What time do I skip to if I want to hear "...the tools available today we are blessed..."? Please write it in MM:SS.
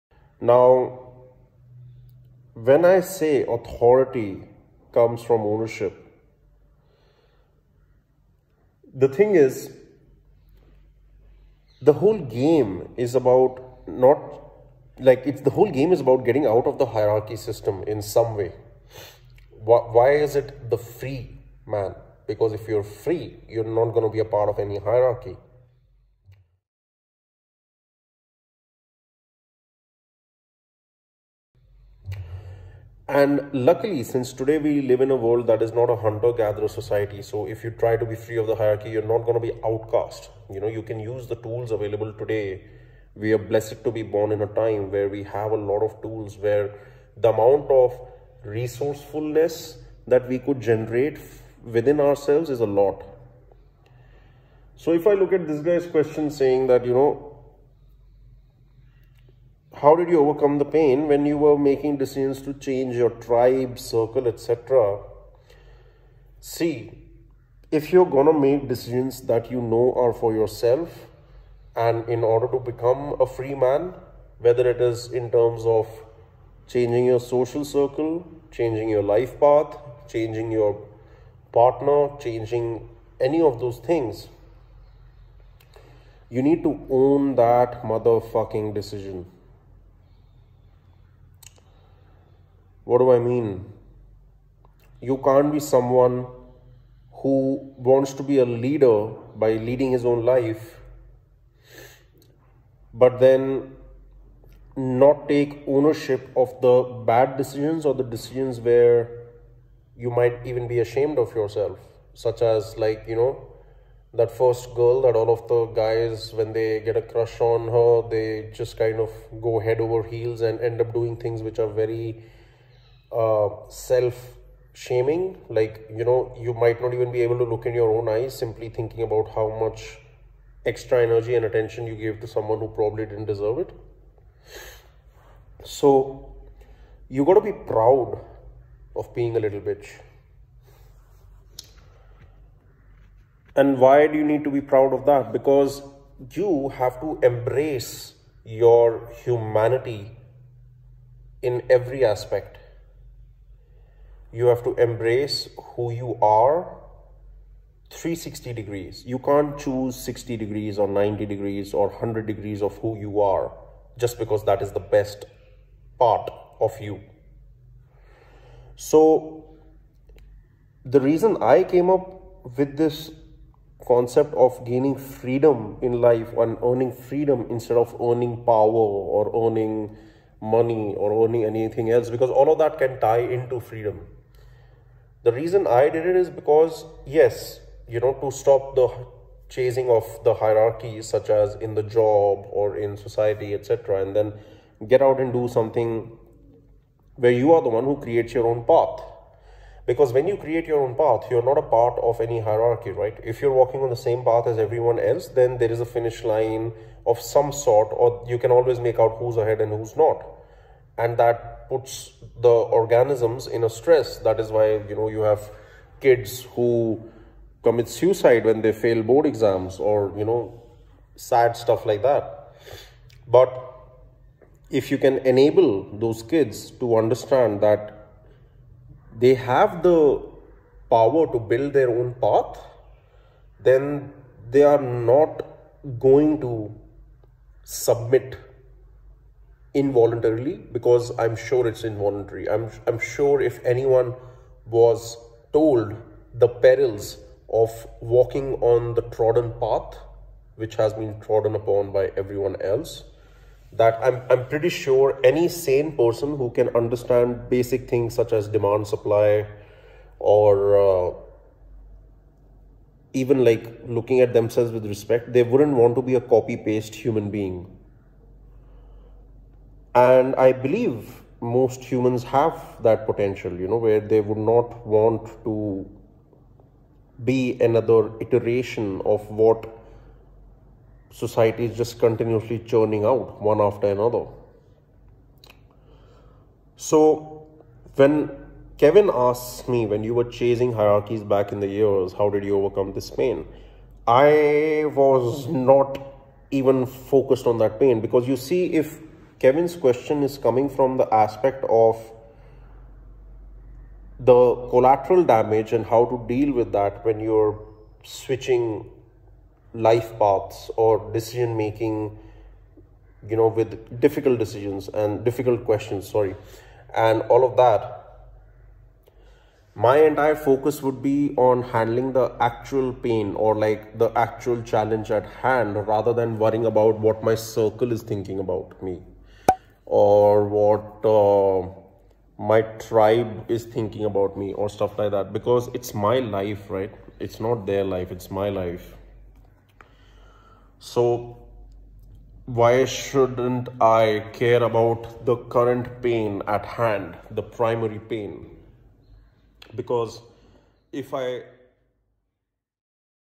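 00:41.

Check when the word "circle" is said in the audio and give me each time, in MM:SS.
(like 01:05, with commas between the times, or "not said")
01:03, 01:17, 05:27.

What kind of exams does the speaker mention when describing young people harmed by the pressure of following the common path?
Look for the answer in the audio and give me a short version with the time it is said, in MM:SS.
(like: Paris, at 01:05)
Board exams, at 03:39.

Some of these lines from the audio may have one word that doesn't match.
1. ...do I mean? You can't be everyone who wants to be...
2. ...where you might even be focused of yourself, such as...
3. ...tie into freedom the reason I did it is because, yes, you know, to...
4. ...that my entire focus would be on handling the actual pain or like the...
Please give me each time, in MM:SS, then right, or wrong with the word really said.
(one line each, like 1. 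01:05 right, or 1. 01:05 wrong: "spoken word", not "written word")
1. 01:32 wrong: "someone", not "everyone"
2. 01:48 wrong: "ashamed", not "focused"
3. 03:03 right
4. 05:17 right.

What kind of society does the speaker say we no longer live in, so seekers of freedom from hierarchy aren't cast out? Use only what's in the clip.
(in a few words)
Hunter gatherer society.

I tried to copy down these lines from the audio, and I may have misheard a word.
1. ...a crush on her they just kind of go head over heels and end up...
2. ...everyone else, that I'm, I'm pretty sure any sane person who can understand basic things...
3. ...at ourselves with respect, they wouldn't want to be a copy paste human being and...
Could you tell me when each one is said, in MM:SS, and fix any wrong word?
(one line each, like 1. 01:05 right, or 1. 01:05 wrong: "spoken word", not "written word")
1. 01:56 right
2. 04:12 right
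3. 04:24 wrong: "themselves", not "ourselves".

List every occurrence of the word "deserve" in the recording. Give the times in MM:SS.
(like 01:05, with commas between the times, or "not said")
02:13.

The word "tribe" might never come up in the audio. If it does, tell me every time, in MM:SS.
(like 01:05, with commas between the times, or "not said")
01:03, 05:32.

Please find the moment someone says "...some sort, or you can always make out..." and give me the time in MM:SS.
03:27.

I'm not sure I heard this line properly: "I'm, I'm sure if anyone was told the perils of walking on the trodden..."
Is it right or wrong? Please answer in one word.
right.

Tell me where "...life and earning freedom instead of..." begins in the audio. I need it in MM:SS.
02:55.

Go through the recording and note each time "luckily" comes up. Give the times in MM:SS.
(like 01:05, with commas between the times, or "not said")
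00:33.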